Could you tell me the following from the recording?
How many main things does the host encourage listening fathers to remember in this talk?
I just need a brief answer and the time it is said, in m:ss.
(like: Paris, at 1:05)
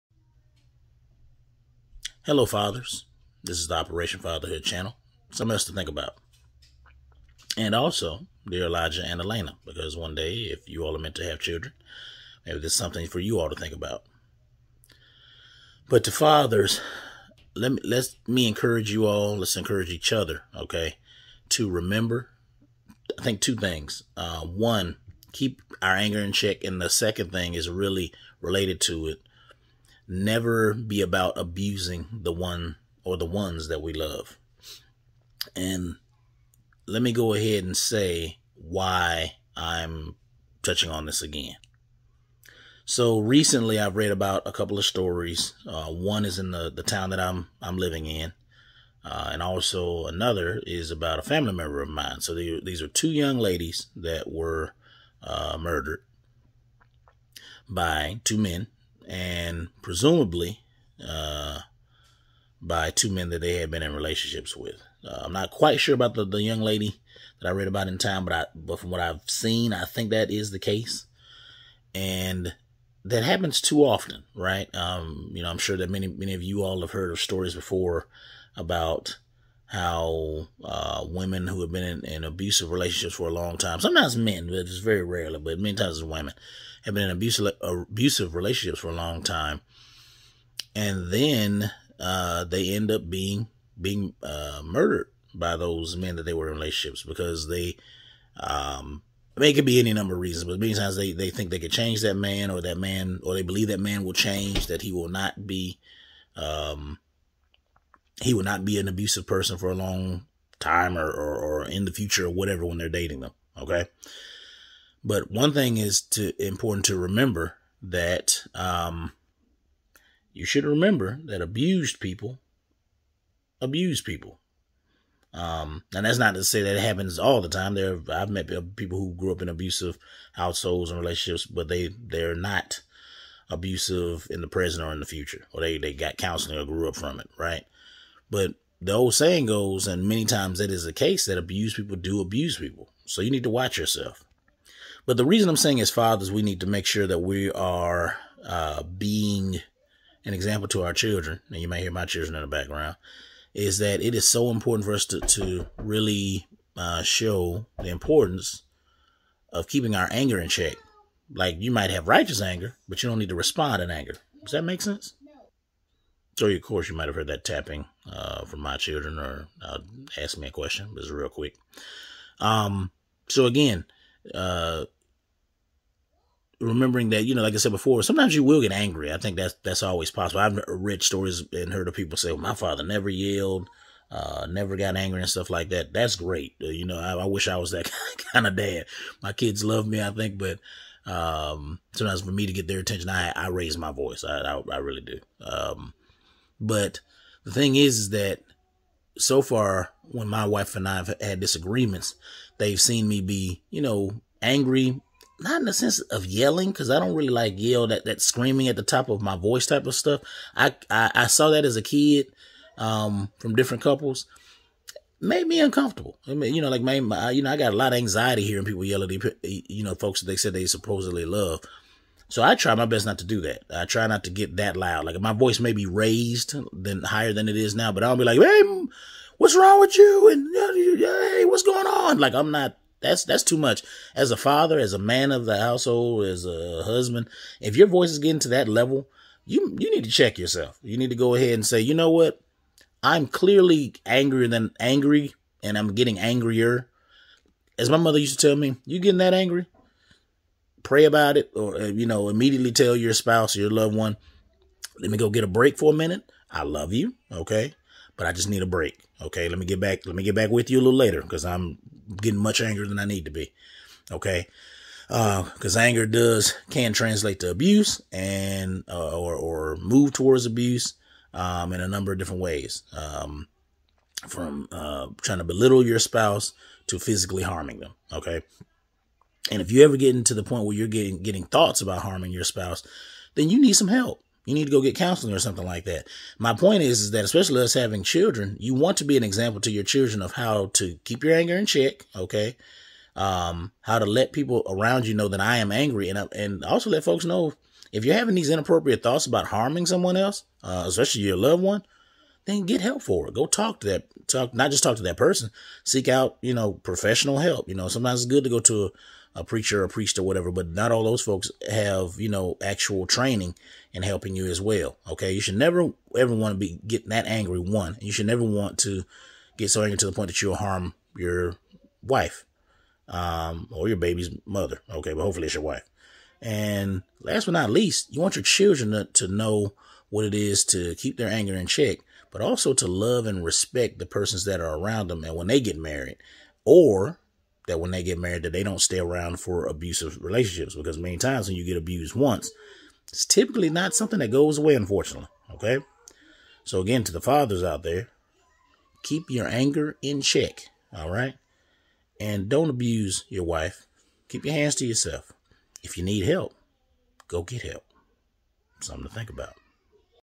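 2, at 0:23.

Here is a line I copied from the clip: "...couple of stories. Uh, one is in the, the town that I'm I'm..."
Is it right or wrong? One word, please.
right.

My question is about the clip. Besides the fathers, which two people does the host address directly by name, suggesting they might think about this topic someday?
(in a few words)
Elijah and Elena.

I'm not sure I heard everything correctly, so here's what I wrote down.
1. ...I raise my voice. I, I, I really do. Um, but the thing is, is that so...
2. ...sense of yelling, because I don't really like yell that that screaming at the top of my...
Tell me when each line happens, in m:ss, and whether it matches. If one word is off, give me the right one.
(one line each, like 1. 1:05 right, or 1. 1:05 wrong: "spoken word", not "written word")
1. 3:13 right
2. 3:25 right.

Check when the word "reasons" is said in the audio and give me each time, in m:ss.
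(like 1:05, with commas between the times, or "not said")
1:40, 2:25.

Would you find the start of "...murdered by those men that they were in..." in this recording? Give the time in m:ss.
1:34.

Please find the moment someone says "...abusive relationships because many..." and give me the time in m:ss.
5:39.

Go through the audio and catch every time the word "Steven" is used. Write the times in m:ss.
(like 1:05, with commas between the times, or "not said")
not said.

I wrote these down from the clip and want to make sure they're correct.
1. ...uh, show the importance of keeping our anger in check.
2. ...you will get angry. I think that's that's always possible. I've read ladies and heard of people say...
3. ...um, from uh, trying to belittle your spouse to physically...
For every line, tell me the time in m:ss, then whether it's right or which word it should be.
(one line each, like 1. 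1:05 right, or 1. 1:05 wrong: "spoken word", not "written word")
1. 2:36 right
2. 2:58 wrong: "stories", not "ladies"
3. 4:32 right.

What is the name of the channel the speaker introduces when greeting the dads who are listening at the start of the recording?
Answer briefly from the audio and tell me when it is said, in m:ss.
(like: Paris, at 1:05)
Operation Fatherhood, at 0:03.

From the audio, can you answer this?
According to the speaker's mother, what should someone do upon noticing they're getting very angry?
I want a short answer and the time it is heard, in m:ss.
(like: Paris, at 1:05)
Pray about it, at 4:10.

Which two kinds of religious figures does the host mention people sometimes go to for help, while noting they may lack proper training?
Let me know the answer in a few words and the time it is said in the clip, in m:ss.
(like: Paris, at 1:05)
A preacher, a priest, at 5:09.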